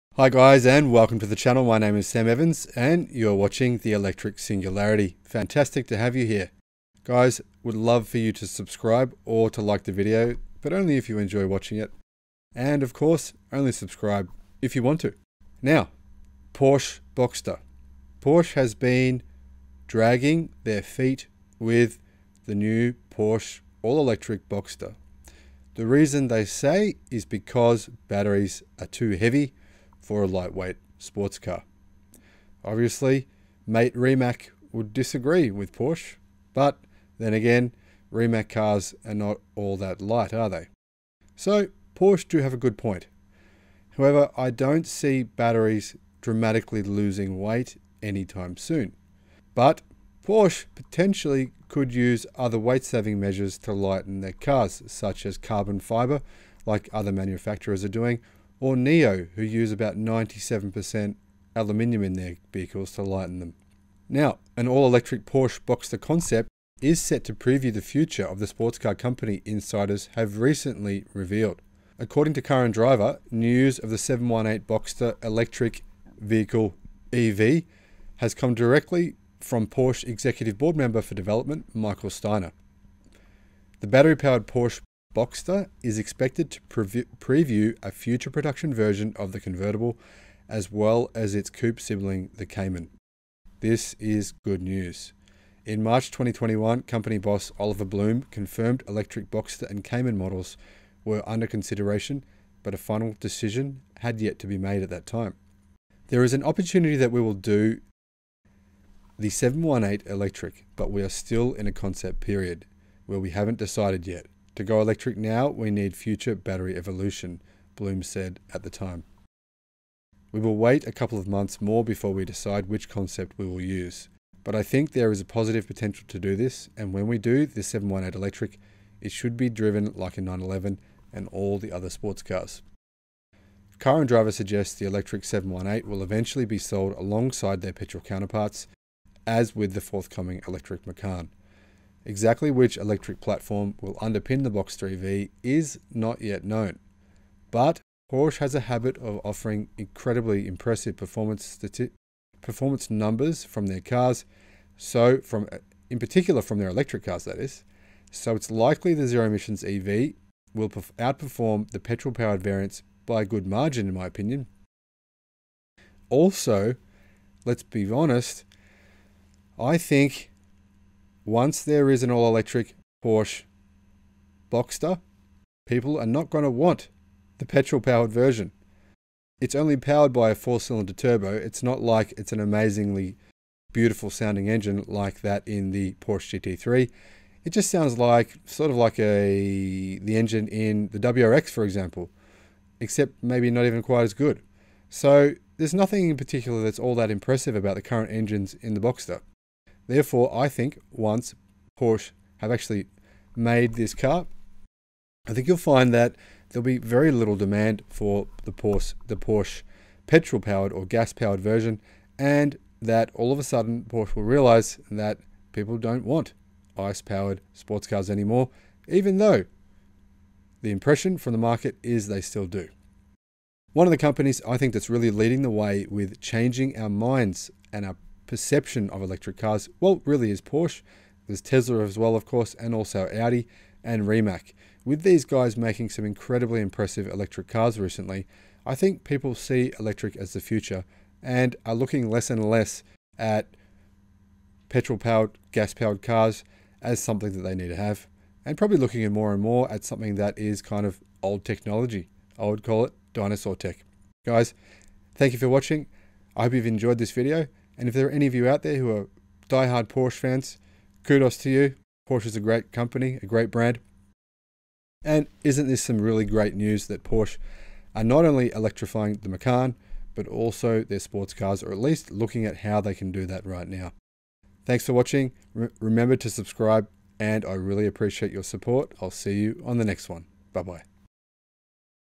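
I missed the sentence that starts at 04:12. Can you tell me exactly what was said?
I would call it dinosaur tech.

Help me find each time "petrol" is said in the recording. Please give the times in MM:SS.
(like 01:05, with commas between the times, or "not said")
02:17, 02:41, 02:57, 03:30, 04:04.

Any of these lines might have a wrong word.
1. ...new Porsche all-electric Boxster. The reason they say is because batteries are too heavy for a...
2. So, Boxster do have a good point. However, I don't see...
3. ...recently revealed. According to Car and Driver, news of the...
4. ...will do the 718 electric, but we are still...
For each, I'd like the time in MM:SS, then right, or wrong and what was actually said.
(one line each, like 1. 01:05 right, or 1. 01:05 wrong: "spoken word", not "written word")
1. 00:22 right
2. 00:41 wrong: "Porsche", not "Boxster"
3. 01:10 right
4. 01:47 right.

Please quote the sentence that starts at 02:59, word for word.
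It's only powered by a four cylinder turbo.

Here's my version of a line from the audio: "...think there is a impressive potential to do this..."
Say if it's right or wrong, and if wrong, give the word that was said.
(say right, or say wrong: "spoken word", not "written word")
wrong: "positive", not "impressive".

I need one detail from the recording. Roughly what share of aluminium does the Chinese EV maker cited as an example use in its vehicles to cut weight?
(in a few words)
97%.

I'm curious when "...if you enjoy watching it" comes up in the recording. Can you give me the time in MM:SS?
00:10.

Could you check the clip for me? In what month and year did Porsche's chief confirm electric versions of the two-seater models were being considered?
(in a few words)
March 2021.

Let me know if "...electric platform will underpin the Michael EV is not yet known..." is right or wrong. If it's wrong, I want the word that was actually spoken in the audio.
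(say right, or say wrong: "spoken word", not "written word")
wrong: "Boxster", not "Michael".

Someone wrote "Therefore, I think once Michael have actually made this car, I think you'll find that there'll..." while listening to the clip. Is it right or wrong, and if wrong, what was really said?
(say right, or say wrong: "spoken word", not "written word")
wrong: "Porsche", not "Michael".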